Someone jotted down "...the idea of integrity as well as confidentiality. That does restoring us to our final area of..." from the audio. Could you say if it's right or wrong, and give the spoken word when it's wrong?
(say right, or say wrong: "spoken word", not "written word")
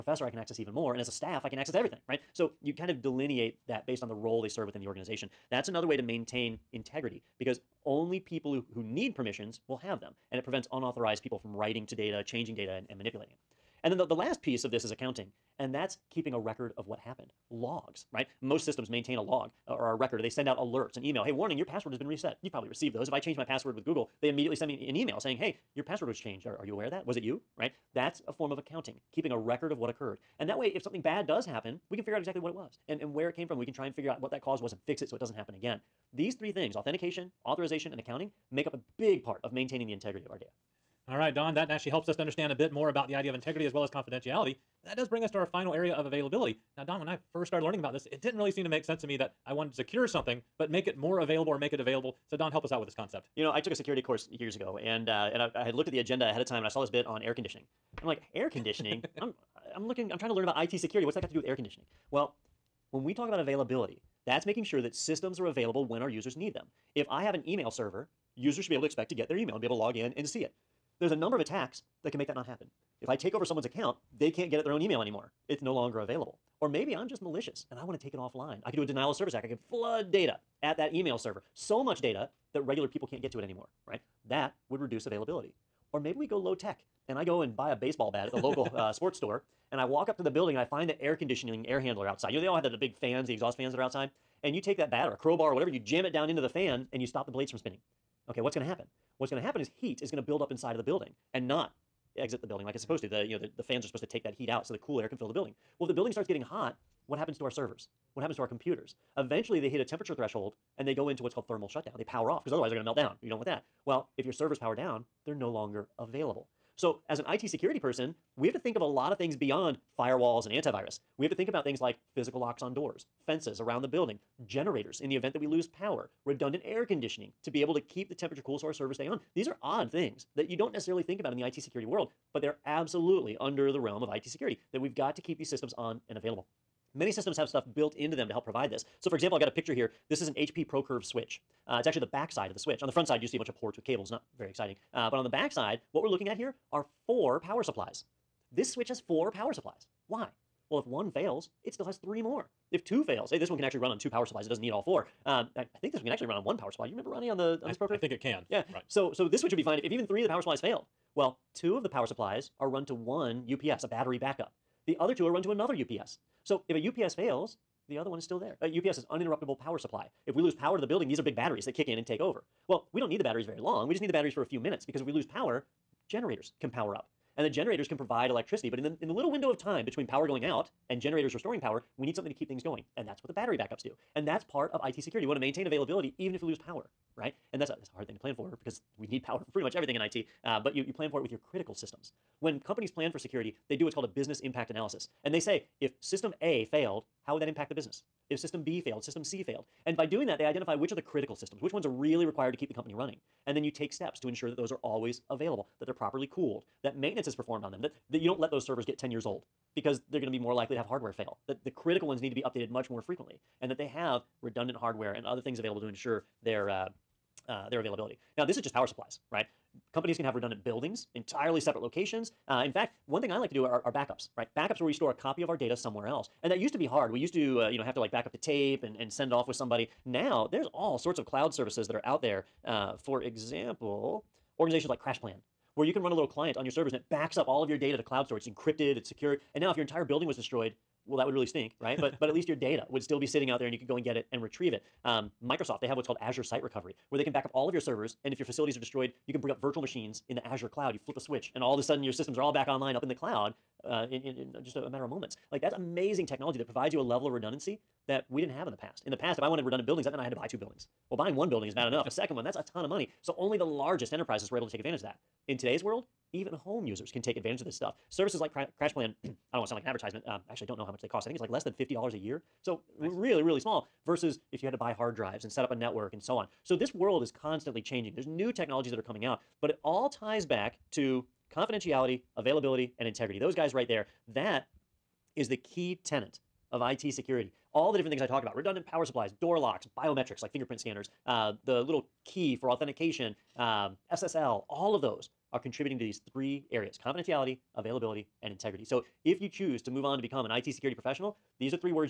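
wrong: "bring", not "restoring".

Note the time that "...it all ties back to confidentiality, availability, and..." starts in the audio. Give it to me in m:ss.
4:39.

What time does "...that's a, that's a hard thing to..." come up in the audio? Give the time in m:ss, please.
3:07.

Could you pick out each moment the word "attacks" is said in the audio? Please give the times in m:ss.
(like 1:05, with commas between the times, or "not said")
1:11, 1:19.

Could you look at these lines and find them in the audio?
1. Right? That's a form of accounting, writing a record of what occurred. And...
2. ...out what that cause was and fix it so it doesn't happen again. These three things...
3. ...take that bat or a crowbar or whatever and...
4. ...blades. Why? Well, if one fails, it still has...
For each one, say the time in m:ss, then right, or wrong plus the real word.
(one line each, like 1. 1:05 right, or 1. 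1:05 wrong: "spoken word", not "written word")
1. 0:27 wrong: "keeping", not "writing"
2. 0:34 right
3. 1:34 right
4. 2:29 wrong: "supplies", not "blades".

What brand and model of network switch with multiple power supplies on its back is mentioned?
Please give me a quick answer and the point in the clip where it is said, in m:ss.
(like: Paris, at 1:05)
HP ProCurve, at 2:20.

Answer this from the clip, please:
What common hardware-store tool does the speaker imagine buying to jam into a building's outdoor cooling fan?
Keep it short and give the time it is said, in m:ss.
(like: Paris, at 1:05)
baseball bat, at 1:27.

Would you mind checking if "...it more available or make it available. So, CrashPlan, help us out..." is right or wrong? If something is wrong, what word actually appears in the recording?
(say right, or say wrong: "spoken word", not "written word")
wrong: "Don", not "CrashPlan".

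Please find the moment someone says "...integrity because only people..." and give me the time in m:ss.
0:06.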